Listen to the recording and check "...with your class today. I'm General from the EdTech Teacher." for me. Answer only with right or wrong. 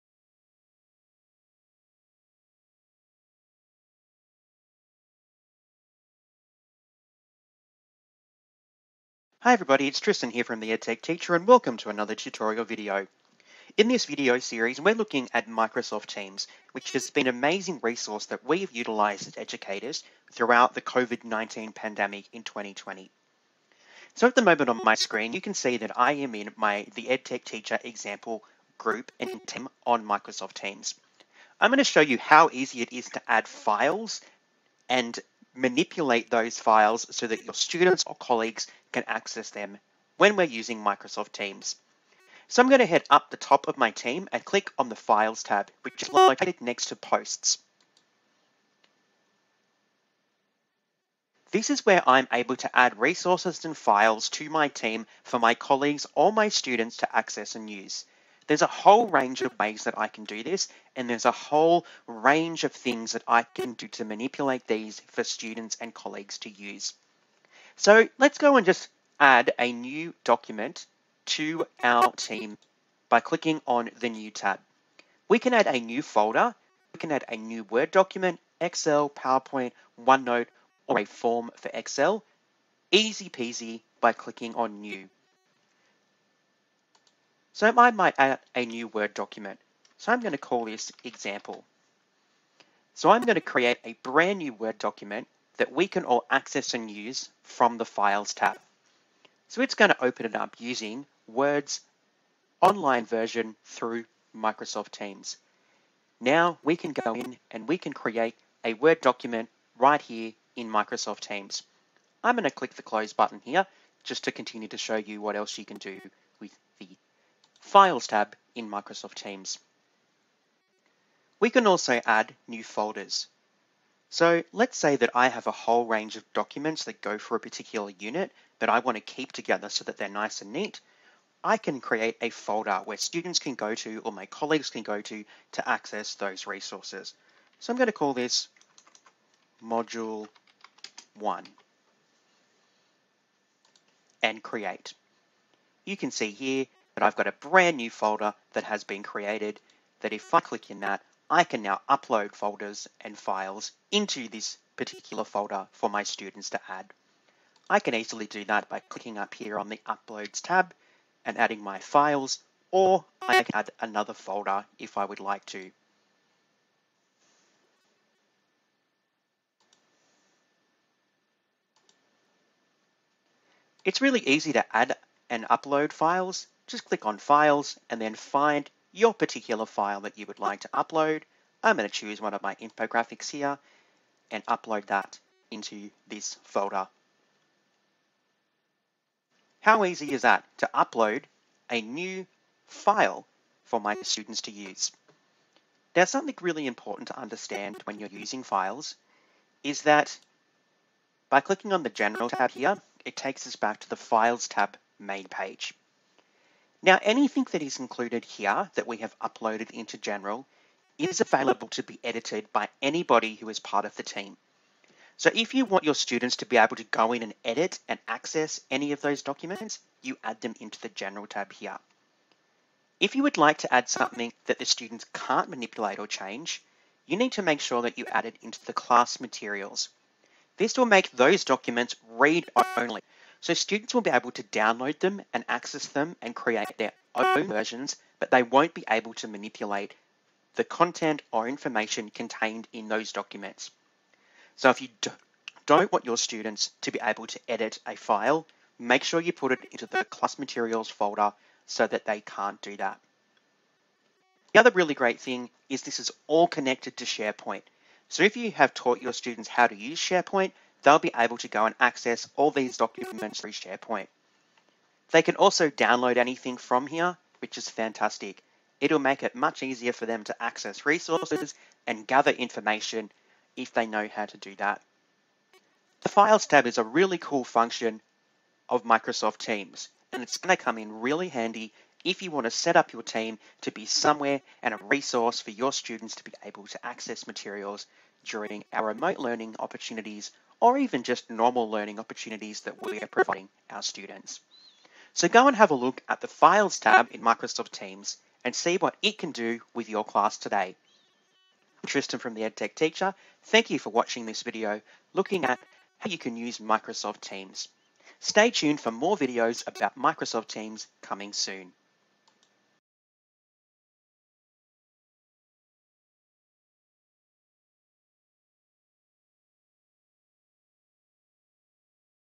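wrong.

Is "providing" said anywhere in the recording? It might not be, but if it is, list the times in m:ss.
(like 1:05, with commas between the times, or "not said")
4:53.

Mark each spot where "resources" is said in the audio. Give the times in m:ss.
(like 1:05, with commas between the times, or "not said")
0:17, 0:52, 2:16, 4:30, 4:44.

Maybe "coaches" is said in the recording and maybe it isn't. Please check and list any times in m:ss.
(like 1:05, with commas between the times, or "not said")
not said.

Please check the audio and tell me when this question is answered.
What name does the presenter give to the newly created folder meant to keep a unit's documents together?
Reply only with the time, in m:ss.
2:19.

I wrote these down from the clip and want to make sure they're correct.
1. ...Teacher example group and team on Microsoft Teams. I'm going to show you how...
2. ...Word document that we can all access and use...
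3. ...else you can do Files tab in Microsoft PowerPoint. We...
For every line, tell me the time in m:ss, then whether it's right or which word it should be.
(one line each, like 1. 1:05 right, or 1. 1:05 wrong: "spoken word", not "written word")
1. 0:27 right
2. 1:34 right
3. 1:55 wrong: "Teams", not "PowerPoint".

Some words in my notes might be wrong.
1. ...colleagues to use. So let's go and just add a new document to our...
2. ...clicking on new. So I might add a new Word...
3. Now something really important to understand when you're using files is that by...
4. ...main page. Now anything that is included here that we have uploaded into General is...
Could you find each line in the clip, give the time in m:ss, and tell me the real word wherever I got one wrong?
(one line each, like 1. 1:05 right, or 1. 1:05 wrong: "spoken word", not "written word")
1. 1:05 right
2. 1:24 right
3. 3:15 right
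4. 3:25 right.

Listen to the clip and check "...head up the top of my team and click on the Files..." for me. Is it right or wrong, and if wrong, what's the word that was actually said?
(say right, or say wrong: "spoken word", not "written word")
right.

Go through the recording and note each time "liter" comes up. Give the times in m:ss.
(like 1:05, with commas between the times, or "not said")
not said.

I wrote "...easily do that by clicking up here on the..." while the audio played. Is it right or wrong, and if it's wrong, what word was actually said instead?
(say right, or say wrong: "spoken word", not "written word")
right.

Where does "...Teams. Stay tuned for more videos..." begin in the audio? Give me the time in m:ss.
5:07.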